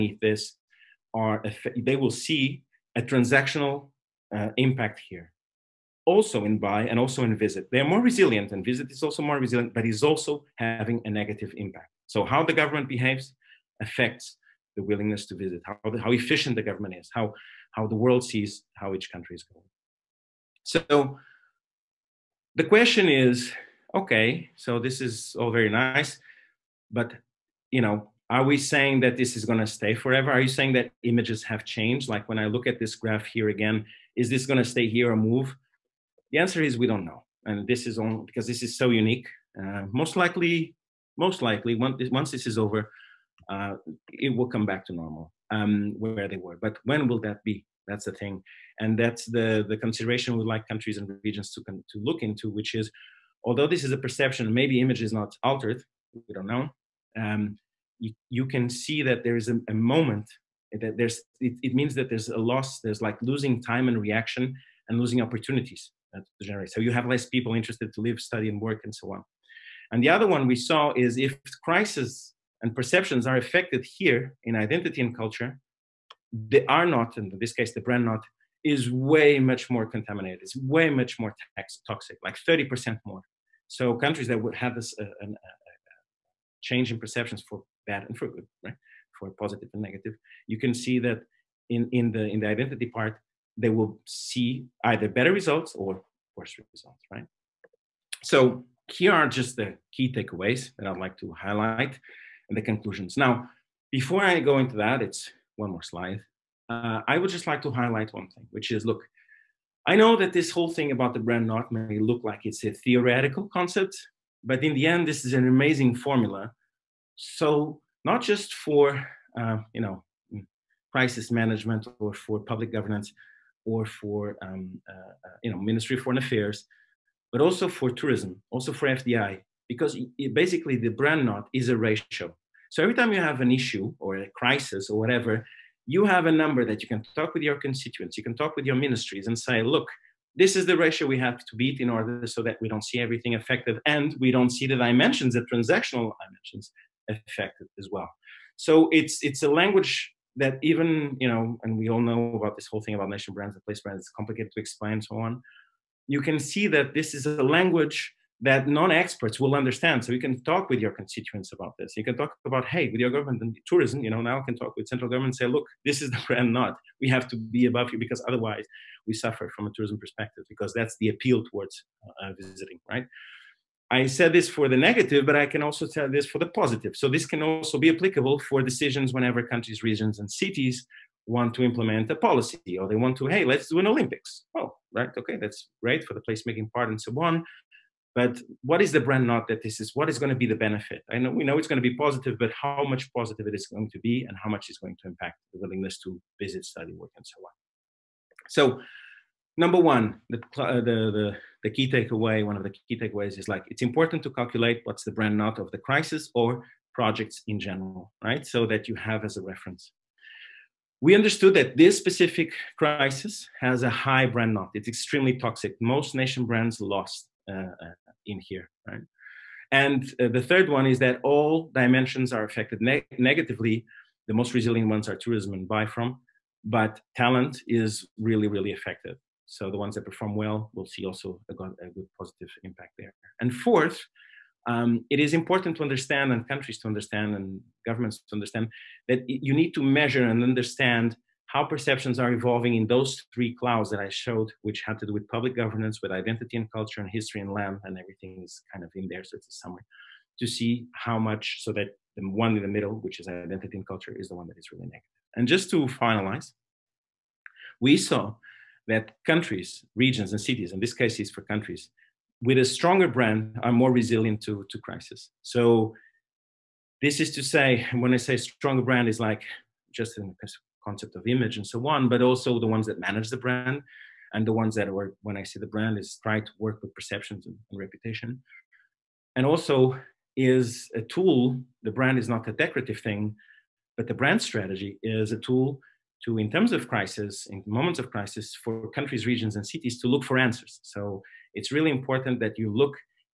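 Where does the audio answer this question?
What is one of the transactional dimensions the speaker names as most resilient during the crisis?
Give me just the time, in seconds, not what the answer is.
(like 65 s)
225 s.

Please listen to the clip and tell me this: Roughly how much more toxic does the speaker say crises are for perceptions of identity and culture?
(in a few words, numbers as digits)
30%.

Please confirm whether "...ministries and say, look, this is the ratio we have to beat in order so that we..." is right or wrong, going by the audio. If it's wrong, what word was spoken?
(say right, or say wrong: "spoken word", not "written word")
right.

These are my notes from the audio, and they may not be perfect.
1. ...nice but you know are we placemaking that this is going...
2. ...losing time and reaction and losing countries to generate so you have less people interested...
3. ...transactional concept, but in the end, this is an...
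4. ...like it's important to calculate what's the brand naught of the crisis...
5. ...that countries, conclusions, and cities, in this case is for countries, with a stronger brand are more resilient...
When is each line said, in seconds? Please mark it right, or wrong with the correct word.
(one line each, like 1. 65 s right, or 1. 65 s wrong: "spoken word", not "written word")
1. 25 s wrong: "saying", not "placemaking"
2. 63 s wrong: "opportunities", not "countries"
3. 112 s wrong: "theoretical", not "transactional"
4. 203 s right
5. 258 s wrong: "regions", not "conclusions".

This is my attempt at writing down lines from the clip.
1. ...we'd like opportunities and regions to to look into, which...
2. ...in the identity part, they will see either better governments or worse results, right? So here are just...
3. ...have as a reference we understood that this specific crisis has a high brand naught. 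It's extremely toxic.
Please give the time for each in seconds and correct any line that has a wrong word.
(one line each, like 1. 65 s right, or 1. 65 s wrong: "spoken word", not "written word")
1. 50 s wrong: "countries", not "opportunities"
2. 92 s wrong: "results", not "governments"
3. 208 s right.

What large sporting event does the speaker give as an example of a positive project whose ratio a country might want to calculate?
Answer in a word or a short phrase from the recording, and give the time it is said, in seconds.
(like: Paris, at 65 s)
Olympics, at 183 s.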